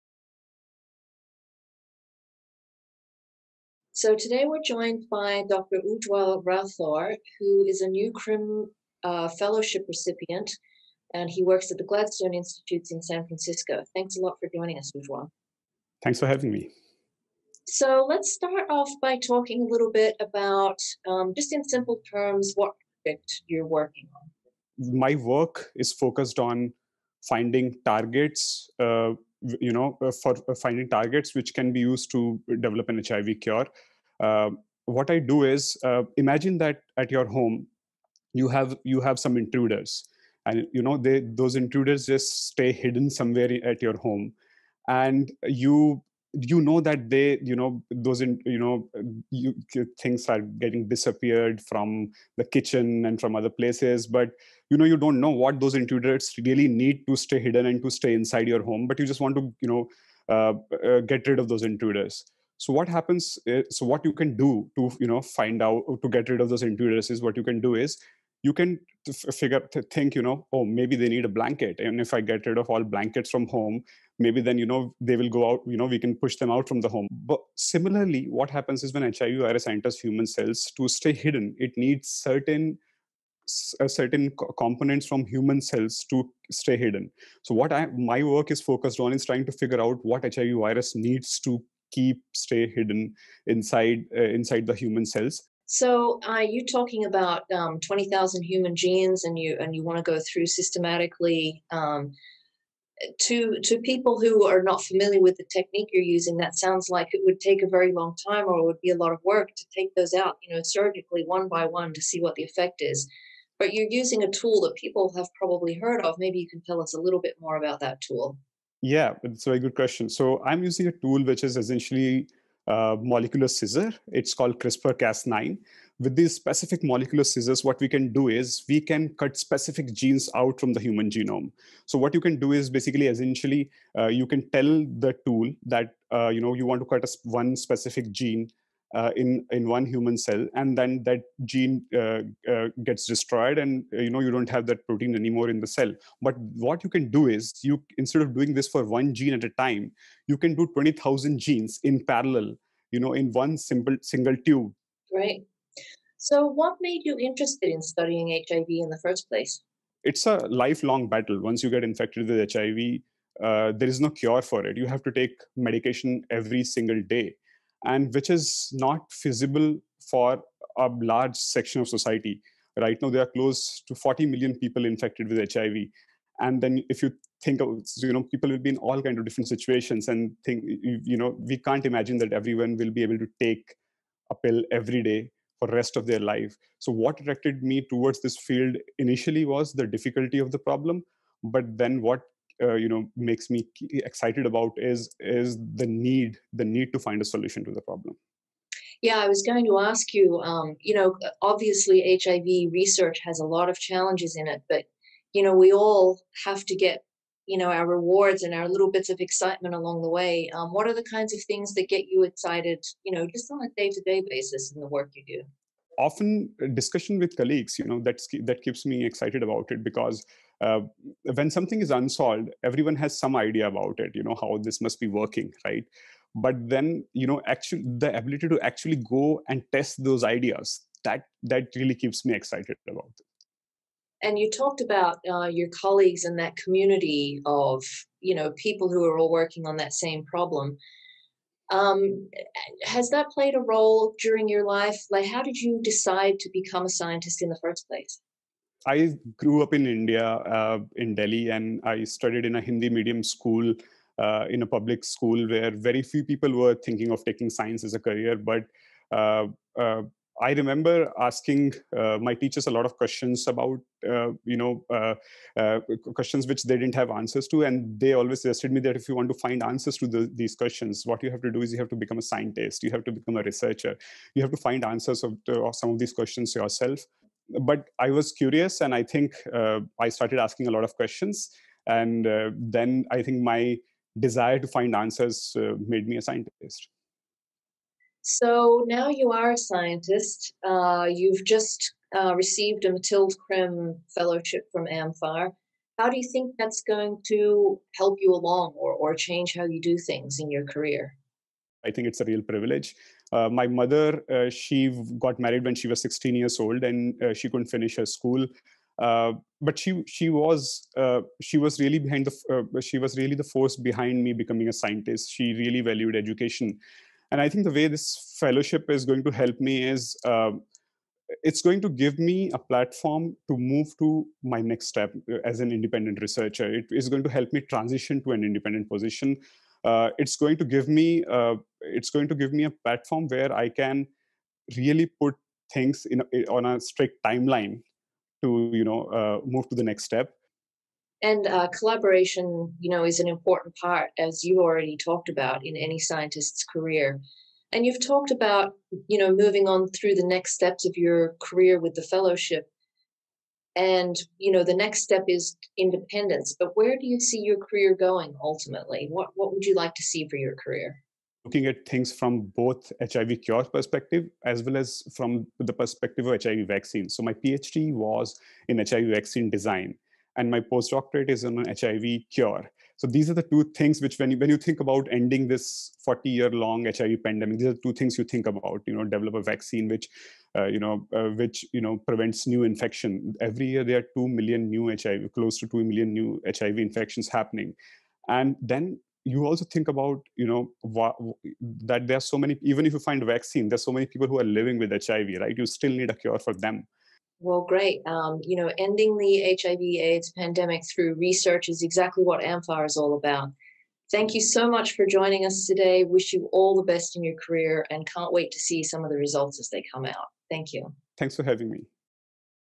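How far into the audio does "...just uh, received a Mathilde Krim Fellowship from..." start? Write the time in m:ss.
4:51.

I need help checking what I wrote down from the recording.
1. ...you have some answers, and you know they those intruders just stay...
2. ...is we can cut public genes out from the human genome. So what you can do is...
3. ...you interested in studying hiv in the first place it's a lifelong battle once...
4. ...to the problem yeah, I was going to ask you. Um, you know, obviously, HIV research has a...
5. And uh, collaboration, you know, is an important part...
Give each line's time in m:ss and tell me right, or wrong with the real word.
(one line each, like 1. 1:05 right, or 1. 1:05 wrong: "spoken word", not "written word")
1. 0:38 wrong: "intruders", not "answers"
2. 2:08 wrong: "specific", not "public"
3. 2:37 right
4. 3:17 right
5. 5:41 right.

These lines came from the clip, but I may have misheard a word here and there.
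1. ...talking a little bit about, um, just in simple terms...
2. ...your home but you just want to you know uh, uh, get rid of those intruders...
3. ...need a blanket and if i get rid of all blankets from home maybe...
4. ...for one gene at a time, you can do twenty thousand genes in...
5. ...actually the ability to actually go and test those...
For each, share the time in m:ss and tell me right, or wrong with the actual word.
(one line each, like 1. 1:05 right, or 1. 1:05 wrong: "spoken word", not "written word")
1. 0:19 right
2. 0:58 right
3. 1:11 right
4. 2:28 right
5. 3:47 right.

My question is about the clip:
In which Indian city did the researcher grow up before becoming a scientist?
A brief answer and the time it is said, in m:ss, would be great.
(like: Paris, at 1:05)
Delhi, at 4:11.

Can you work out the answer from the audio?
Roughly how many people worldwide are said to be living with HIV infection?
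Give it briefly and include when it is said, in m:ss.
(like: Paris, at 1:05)
40 million, at 2:53.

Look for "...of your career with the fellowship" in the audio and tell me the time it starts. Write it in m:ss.
5:50.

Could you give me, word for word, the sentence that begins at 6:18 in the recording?
You know, develop a vaccine which, uh, you know, uh, which you know prevents new infection.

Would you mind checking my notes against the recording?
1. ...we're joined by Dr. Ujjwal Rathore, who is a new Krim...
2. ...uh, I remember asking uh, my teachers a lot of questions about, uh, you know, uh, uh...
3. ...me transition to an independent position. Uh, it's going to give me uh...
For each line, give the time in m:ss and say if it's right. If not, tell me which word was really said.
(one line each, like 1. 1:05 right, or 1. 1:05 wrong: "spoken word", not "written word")
1. 0:04 right
2. 4:19 right
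3. 5:27 right.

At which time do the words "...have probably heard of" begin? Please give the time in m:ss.
1:55.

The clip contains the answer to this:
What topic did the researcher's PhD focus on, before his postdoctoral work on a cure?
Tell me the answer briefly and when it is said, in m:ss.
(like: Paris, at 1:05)
HIV vaccine design, at 6:08.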